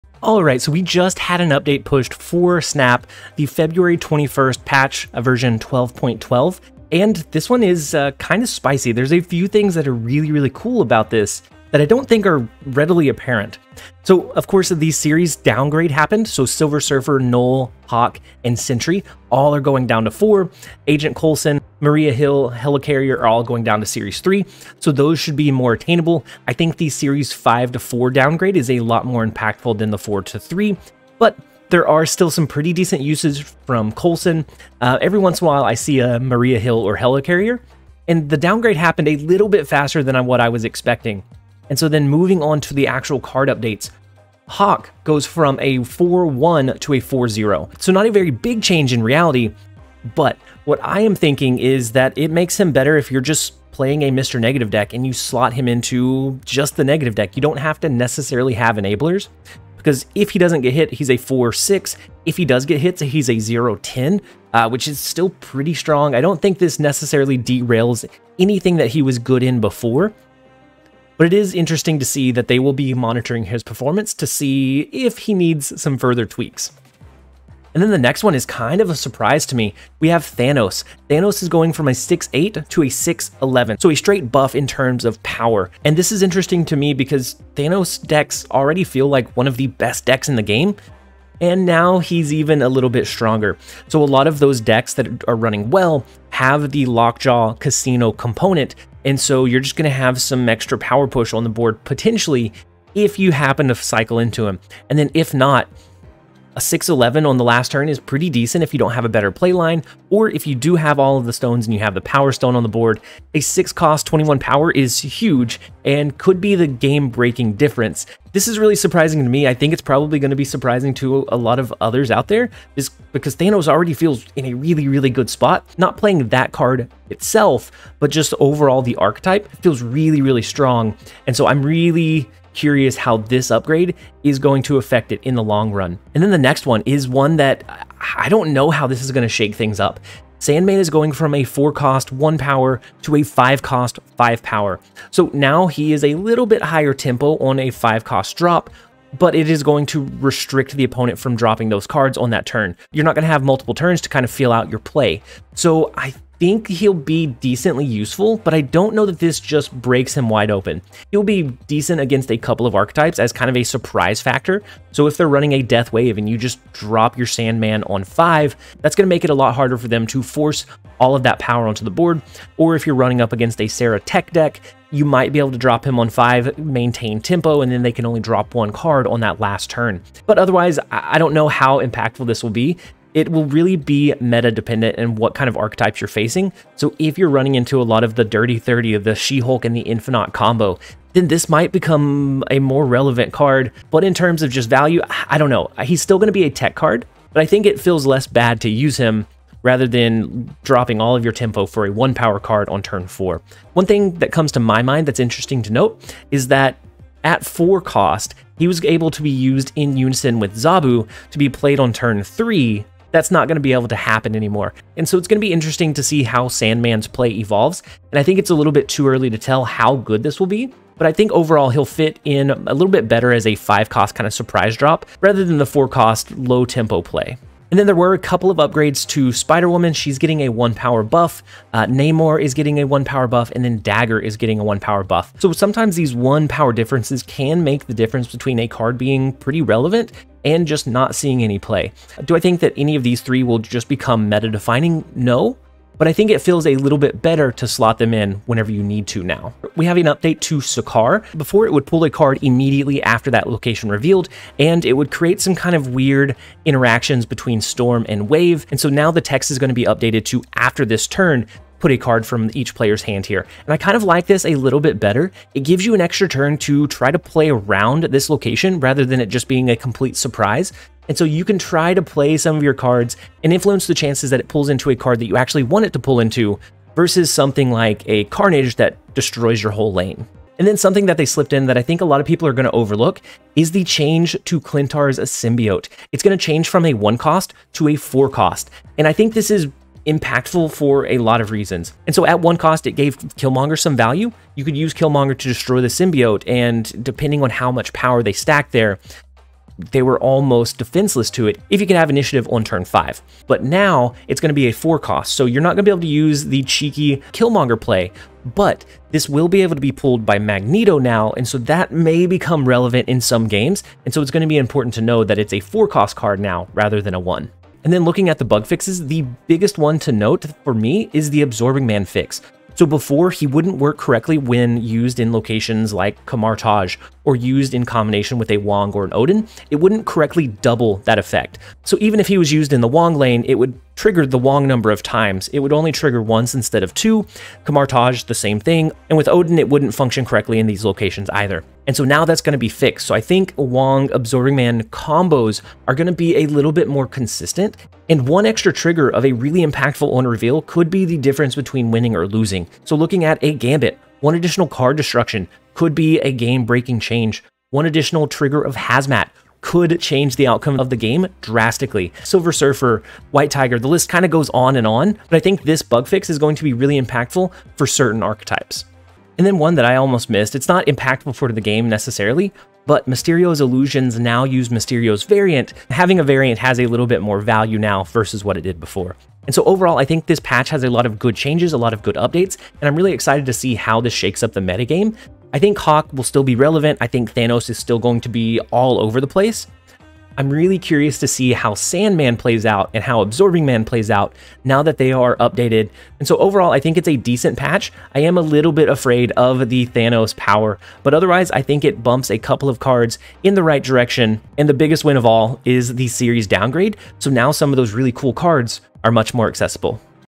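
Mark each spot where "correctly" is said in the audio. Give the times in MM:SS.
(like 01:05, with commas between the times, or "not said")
05:23, 05:30, 05:40.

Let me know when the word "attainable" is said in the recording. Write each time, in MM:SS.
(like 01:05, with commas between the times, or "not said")
00:25.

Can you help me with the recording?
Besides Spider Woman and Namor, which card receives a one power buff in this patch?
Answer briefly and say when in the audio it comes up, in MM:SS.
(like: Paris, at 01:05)
Dagger, at 03:53.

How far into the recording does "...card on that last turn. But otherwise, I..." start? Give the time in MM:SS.
02:58.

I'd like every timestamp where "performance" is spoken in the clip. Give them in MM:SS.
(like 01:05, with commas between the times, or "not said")
01:13.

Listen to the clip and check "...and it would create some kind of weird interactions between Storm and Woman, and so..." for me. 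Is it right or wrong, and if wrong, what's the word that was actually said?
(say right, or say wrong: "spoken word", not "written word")
wrong: "Wave", not "Woman".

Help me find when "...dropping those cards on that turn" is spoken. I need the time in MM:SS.
02:31.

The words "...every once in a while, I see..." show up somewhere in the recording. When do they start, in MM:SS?
00:35.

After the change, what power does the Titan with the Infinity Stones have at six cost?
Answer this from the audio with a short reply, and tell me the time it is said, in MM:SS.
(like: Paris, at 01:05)
11, at 01:22.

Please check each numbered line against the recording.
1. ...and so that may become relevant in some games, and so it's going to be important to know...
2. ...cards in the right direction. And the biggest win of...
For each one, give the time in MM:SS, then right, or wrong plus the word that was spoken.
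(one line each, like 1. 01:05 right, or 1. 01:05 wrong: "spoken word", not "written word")
1. 05:11 right
2. 06:42 right.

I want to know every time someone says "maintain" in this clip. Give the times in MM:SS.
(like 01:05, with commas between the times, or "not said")
02:56.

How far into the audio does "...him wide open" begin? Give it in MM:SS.
02:40.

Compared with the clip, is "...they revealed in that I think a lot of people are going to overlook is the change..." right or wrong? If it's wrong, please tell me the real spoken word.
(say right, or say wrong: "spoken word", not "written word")
wrong: "slipped", not "revealed".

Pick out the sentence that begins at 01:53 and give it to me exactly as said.
A 6 cost 21 power is huge and could be the game breaking difference this is really surprising to me.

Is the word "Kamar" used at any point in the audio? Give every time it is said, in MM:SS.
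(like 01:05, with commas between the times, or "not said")
05:26, 05:37.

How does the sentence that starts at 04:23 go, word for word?
And I kind of like this a little bit better.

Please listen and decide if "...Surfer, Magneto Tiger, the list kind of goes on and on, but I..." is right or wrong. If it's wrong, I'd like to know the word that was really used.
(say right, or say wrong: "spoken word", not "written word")
wrong: "White", not "Magneto".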